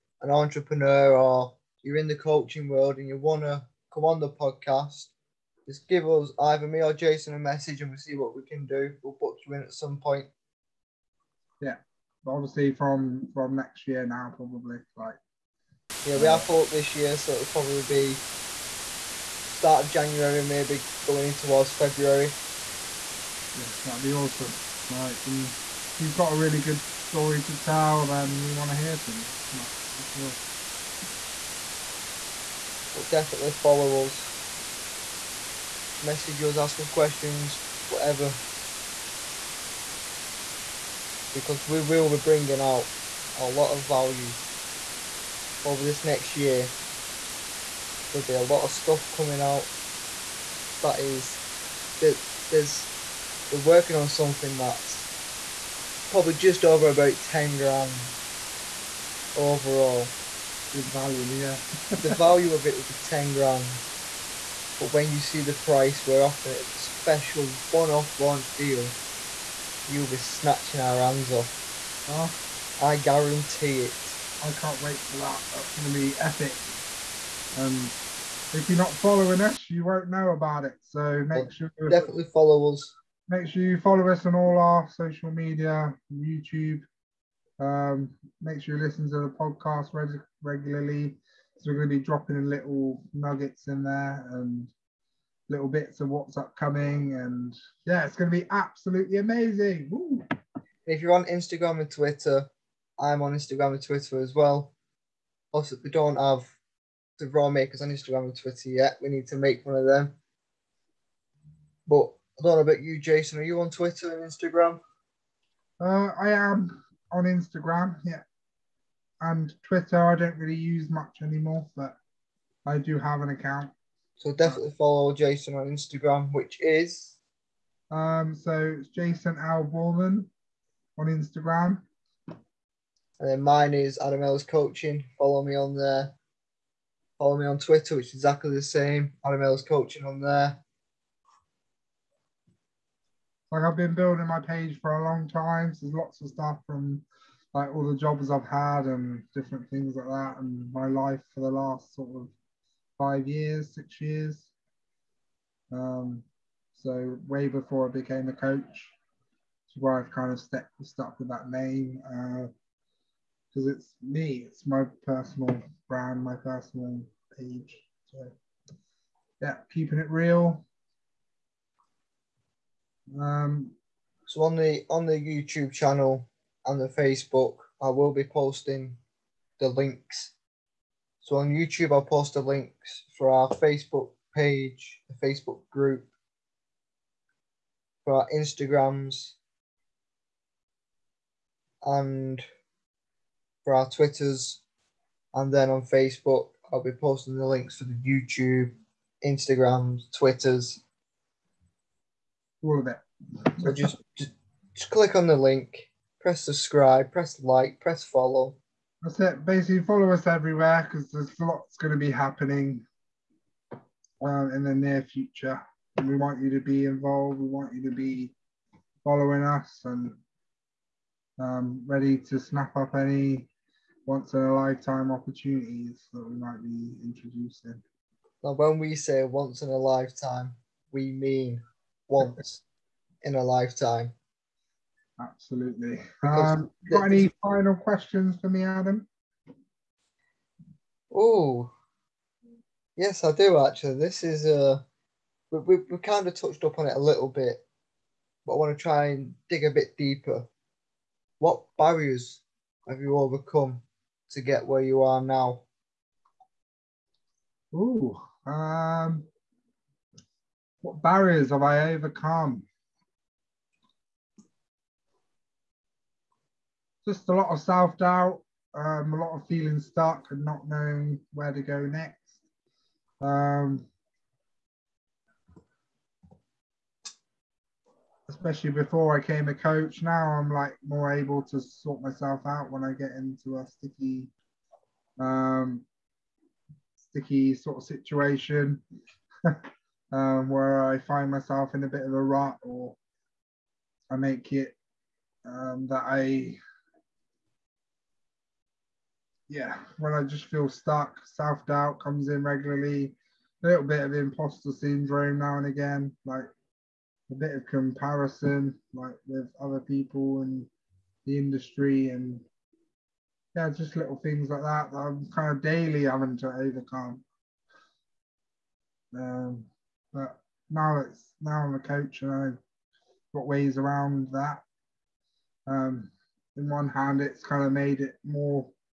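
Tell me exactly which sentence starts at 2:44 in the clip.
It's my personal brand, my personal page.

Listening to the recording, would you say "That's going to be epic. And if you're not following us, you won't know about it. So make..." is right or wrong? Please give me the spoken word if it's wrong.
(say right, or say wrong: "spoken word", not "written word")
right.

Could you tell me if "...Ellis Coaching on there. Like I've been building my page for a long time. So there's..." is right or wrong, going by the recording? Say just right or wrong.
right.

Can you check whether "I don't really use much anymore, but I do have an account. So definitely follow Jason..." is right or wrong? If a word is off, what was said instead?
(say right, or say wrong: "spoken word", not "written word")
right.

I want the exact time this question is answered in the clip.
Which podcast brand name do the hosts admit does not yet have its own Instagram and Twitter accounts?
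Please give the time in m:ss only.
1:47.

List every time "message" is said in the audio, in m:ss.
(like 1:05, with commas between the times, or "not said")
0:07, 0:36.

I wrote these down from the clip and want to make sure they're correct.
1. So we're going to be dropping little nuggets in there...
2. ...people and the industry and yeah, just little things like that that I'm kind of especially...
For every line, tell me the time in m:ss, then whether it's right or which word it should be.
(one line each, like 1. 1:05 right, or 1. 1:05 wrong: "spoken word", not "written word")
1. 1:31 right
2. 5:09 wrong: "daily", not "especially".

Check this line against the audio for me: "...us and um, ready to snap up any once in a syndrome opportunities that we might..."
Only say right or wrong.
wrong.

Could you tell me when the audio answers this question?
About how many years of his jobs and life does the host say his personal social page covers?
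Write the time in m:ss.
2:32.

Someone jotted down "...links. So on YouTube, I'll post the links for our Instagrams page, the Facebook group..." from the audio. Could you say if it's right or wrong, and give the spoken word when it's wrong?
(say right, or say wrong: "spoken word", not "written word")
wrong: "Facebook", not "Instagrams".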